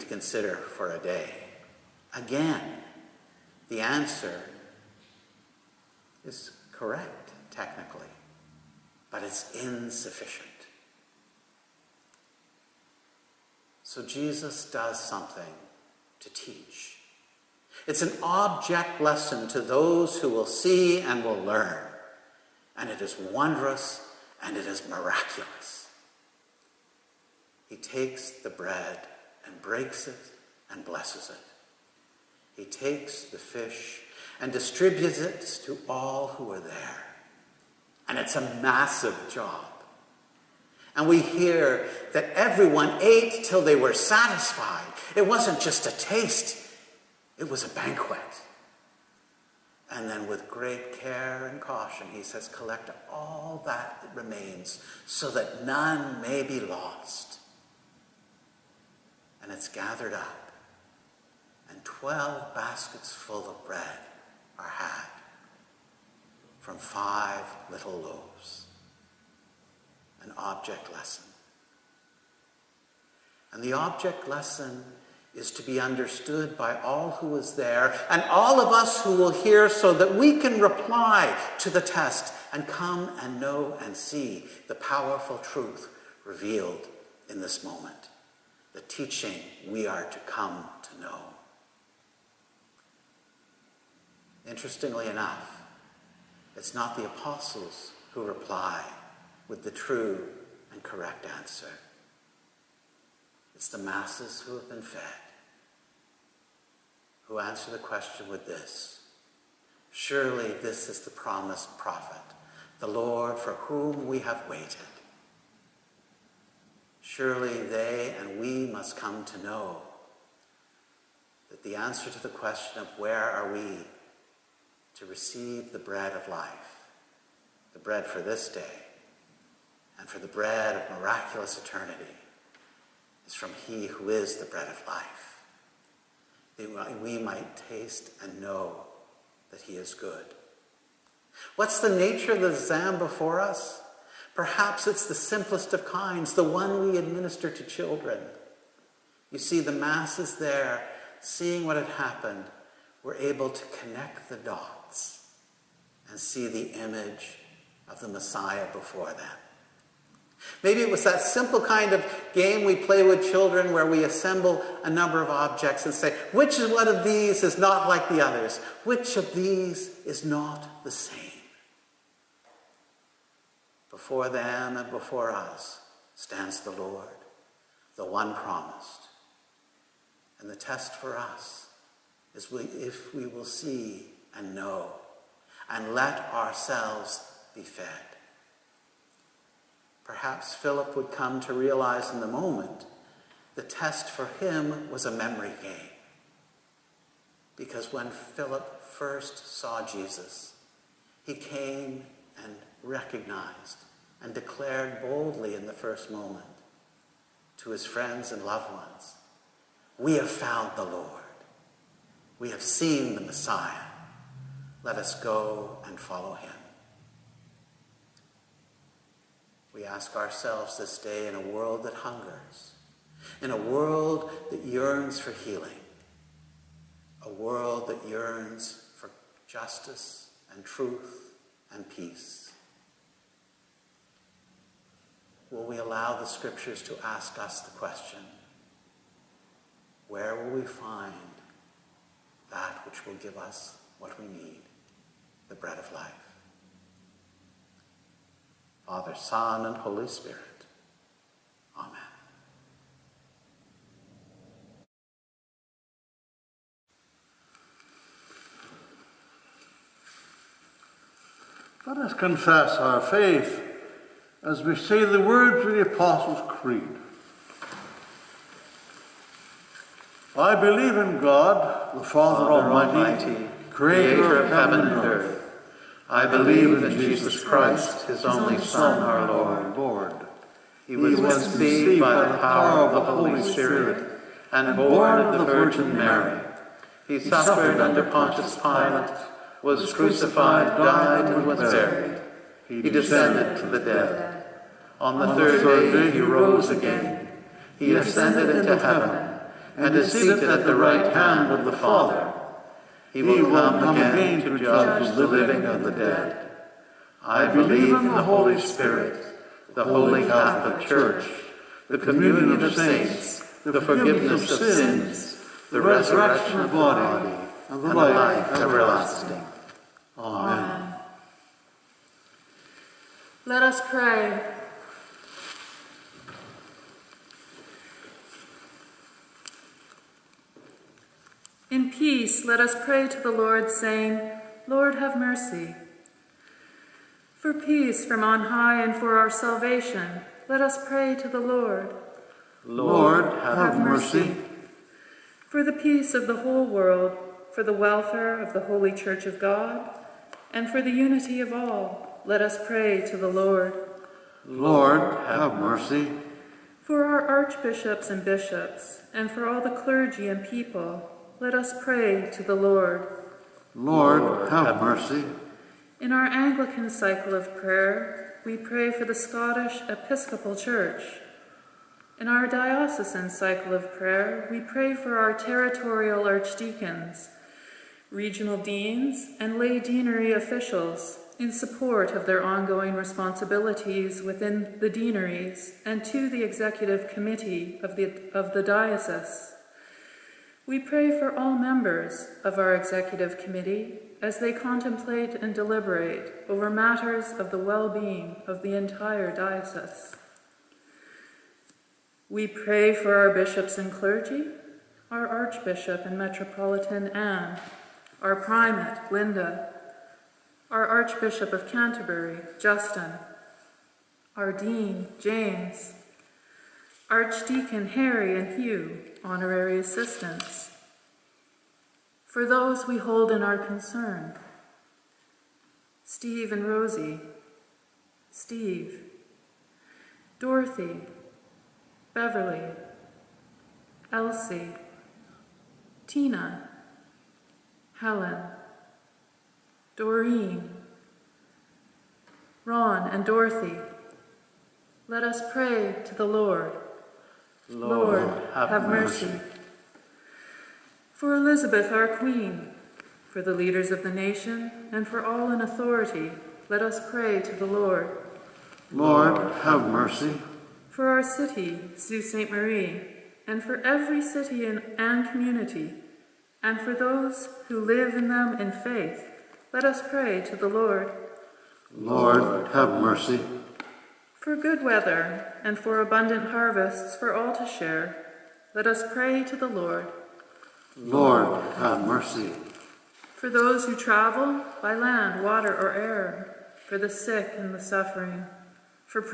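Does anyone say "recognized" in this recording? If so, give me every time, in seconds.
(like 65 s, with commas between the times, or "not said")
202 s.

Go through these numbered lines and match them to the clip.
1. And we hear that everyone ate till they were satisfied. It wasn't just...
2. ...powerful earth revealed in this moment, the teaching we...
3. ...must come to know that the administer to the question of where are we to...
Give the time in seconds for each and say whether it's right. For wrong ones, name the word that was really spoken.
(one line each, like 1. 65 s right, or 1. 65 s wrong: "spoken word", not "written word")
1. 40 s right
2. 84 s wrong: "truth", not "earth"
3. 118 s wrong: "answer", not "administer".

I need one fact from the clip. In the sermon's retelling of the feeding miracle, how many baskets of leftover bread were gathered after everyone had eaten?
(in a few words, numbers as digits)
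12.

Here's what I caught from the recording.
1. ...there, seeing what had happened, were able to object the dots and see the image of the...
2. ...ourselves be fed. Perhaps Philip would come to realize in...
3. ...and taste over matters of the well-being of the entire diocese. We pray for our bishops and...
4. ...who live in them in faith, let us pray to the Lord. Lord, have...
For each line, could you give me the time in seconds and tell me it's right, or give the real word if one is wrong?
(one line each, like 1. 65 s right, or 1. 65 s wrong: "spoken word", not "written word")
1. 150 s wrong: "connect", not "object"
2. 186 s right
3. 395 s wrong: "deliberate", not "taste"
4. 467 s right.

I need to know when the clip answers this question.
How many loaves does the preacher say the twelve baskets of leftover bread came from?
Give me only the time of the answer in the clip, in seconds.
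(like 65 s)
66 s.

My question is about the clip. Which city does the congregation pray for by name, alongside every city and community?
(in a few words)
Sault Ste. Marie.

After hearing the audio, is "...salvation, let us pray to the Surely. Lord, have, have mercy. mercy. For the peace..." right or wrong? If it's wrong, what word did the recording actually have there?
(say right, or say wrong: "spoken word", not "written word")
wrong: "Lord", not "Surely".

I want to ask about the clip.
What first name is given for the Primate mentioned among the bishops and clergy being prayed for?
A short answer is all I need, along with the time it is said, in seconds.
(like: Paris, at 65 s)
Linda, at 409 s.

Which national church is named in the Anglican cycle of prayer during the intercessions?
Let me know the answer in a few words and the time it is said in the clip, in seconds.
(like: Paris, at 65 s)
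Scottish Episcopal Church, at 369 s.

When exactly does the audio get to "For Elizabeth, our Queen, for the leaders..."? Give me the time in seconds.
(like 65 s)
451 s.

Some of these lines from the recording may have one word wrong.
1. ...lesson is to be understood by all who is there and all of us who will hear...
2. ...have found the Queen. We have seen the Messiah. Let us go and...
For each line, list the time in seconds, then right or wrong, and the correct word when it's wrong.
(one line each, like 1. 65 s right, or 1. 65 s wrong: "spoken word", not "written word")
1. 74 s right
2. 210 s wrong: "Lord", not "Queen".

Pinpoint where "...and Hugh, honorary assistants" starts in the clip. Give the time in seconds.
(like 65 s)
418 s.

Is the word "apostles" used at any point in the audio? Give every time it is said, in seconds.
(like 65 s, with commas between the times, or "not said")
97 s, 265 s.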